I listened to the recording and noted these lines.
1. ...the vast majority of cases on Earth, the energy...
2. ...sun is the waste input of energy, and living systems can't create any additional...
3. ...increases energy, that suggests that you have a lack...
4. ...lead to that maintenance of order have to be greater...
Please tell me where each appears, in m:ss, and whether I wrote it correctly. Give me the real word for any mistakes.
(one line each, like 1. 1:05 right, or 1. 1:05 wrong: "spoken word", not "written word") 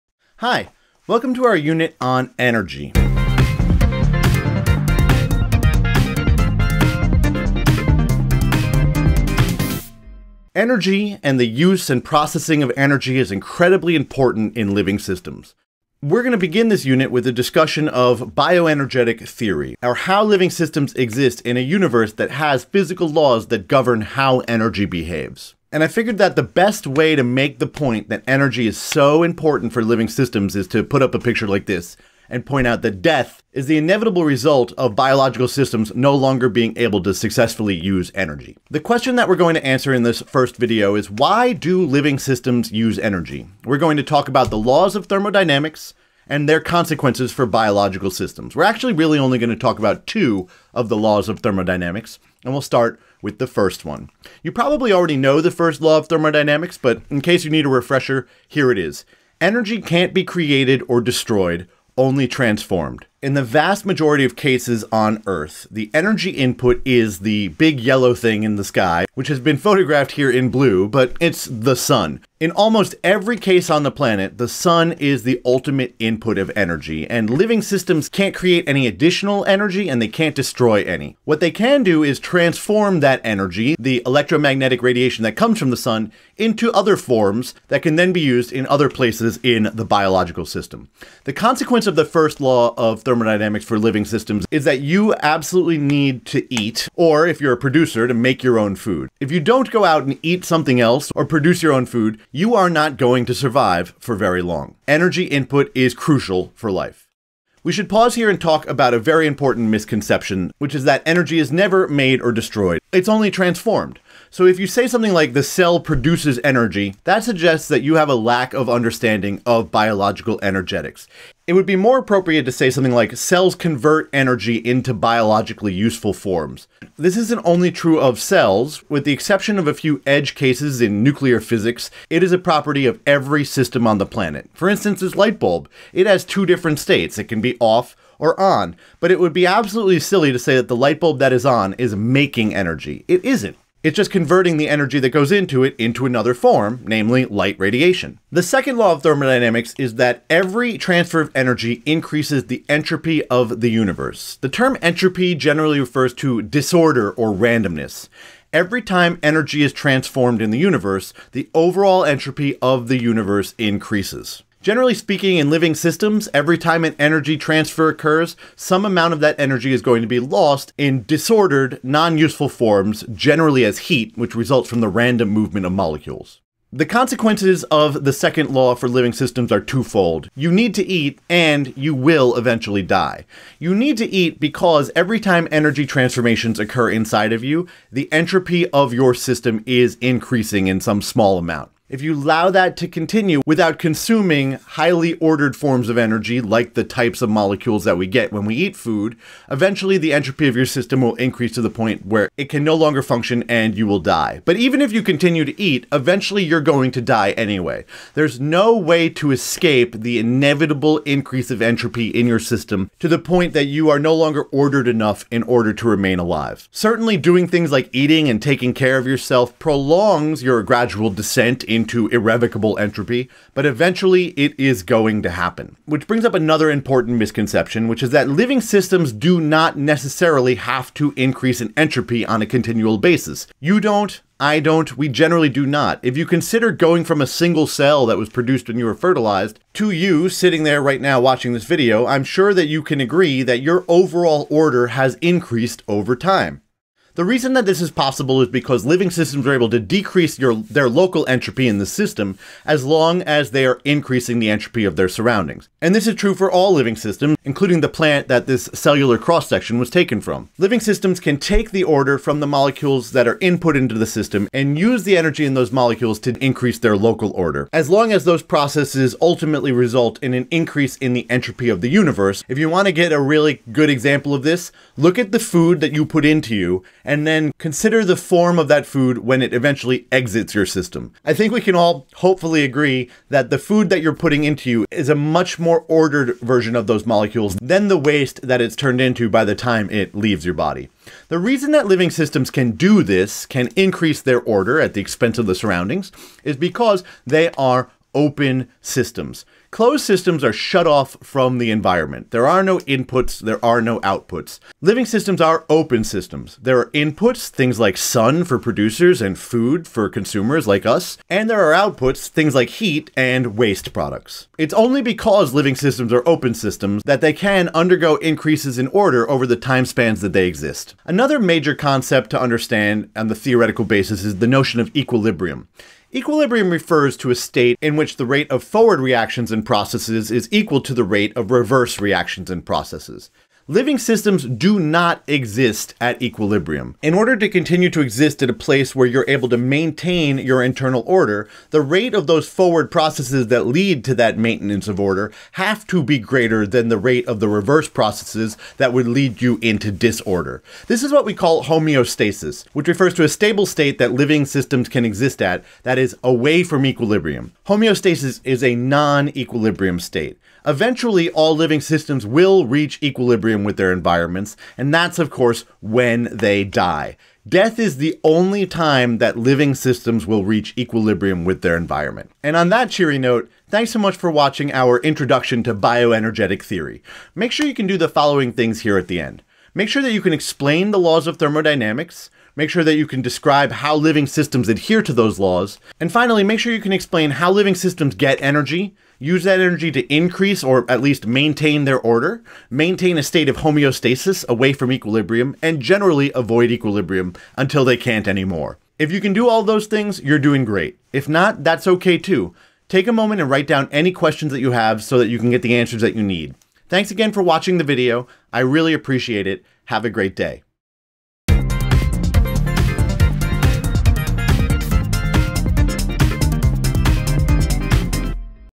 1. 1:03 right
2. 1:14 wrong: "ultimate", not "waste"
3. 1:55 wrong: "produces", not "increases"
4. 5:43 right.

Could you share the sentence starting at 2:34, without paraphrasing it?
The term entropy generally refers to disorder or randomness.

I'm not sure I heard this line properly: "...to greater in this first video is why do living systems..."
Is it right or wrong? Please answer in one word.
wrong.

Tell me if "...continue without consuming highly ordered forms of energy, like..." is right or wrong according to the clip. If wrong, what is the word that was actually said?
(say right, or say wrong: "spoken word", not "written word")
right.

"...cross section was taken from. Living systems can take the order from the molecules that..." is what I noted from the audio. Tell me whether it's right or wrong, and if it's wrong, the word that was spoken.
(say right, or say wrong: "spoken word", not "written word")
right.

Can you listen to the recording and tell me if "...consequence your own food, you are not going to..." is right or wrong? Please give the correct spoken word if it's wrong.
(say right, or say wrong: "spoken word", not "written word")
wrong: "produce", not "consequence".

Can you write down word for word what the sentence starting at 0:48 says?
We're actually really only going to talk about two of the laws of thermodynamics, and we'll start with the first one.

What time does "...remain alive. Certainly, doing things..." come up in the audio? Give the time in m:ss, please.
3:35.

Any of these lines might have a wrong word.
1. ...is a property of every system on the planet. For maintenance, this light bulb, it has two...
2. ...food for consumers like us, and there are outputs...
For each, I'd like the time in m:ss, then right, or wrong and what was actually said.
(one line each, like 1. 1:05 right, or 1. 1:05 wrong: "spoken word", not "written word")
1. 2:12 wrong: "instance", not "maintenance"
2. 5:09 right.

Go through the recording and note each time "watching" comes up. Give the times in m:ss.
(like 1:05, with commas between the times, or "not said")
4:01, 6:14, 6:47.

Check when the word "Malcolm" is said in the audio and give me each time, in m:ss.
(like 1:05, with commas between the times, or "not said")
not said.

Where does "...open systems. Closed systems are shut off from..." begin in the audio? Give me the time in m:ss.
4:58.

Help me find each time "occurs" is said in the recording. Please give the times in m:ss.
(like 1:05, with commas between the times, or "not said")
2:47, 3:06.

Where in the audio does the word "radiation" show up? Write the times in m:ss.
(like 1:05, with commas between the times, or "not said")
1:24, 2:27.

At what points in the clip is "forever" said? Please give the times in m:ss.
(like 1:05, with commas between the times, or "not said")
not said.